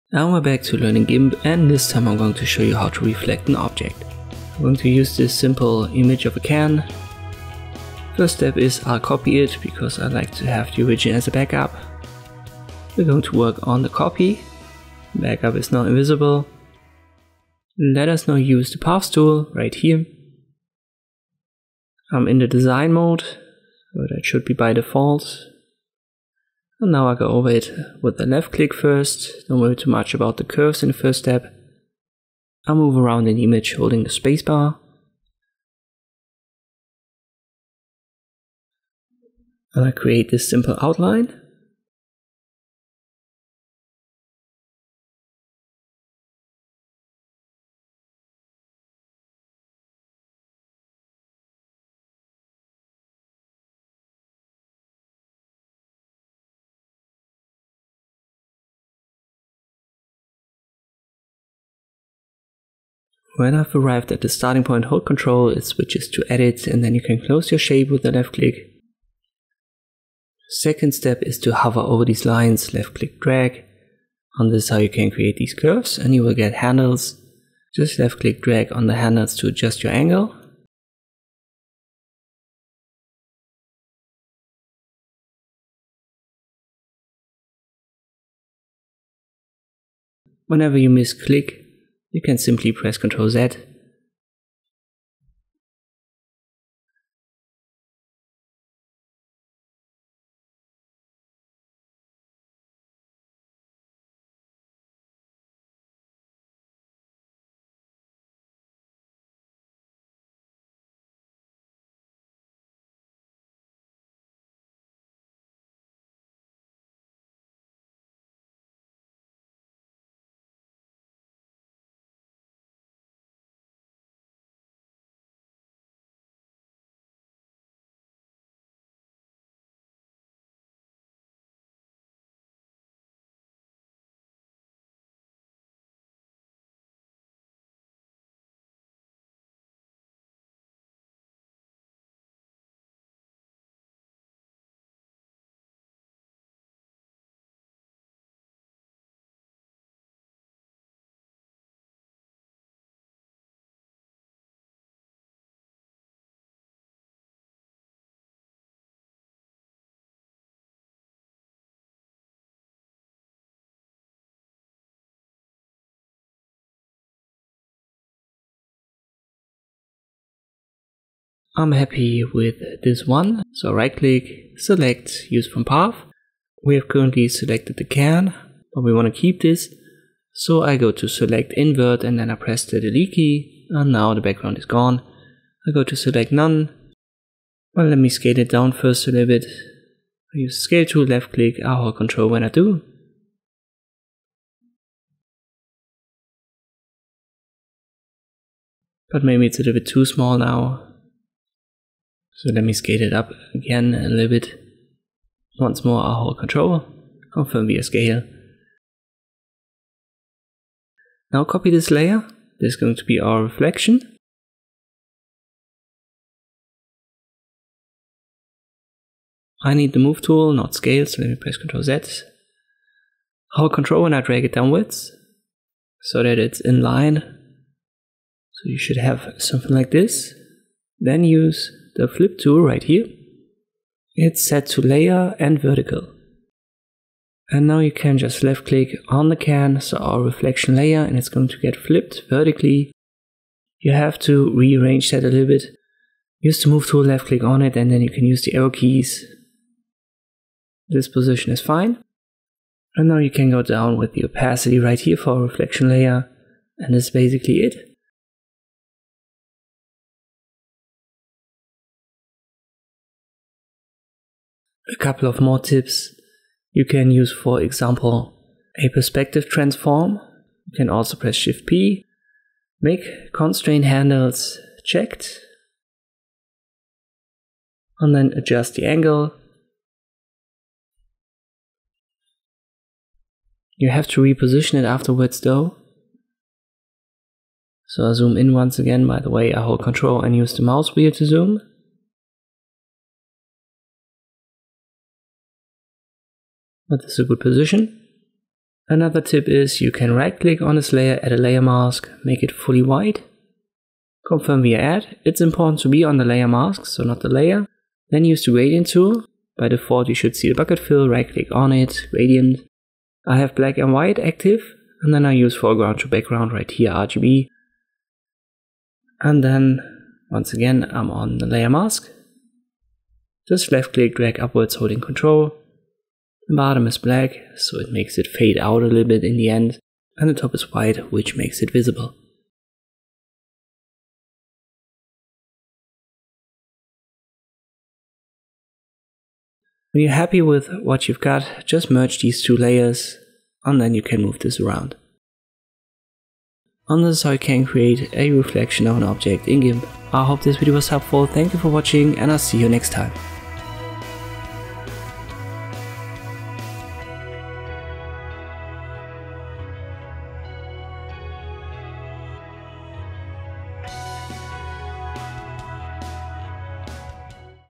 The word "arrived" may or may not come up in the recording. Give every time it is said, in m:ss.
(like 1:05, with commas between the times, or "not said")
1:03.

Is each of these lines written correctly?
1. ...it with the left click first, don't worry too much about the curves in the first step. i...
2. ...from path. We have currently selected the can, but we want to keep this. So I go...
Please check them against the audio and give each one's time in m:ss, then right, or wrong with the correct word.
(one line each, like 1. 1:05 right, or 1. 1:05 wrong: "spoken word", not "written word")
1. 0:27 right
2. 2:55 right.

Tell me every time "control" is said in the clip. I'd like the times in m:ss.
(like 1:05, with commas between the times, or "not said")
1:05, 3:11, 3:26, 4:49, 5:24.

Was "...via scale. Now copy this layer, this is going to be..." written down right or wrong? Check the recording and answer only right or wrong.
right.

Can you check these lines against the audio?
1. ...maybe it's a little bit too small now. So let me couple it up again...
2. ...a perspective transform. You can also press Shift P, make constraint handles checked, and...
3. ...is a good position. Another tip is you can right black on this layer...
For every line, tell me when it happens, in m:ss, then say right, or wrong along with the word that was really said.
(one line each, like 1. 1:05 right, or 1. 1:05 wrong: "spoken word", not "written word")
1. 3:19 wrong: "scale", not "couple"
2. 4:28 right
3. 4:57 wrong: "click", not "black".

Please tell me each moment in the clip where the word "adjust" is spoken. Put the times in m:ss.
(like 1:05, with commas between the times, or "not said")
1:19, 4:38.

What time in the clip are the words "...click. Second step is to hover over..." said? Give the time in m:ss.
1:08.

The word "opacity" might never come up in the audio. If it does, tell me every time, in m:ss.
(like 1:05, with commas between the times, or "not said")
4:14.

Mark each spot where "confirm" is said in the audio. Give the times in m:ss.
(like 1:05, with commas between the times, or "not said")
3:27, 5:04.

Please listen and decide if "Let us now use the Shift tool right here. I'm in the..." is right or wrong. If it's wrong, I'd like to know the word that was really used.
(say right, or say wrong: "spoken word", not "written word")
wrong: "Paths", not "Shift".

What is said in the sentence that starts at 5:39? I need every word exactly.
When you're happy with what you've got, just merge these two layers, and then you can move this around.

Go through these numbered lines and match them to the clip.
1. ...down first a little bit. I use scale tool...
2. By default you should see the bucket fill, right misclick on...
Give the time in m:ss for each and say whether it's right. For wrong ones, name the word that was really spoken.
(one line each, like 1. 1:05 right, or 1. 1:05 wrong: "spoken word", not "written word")
1. 3:08 right
2. 5:09 wrong: "click", not "misclick".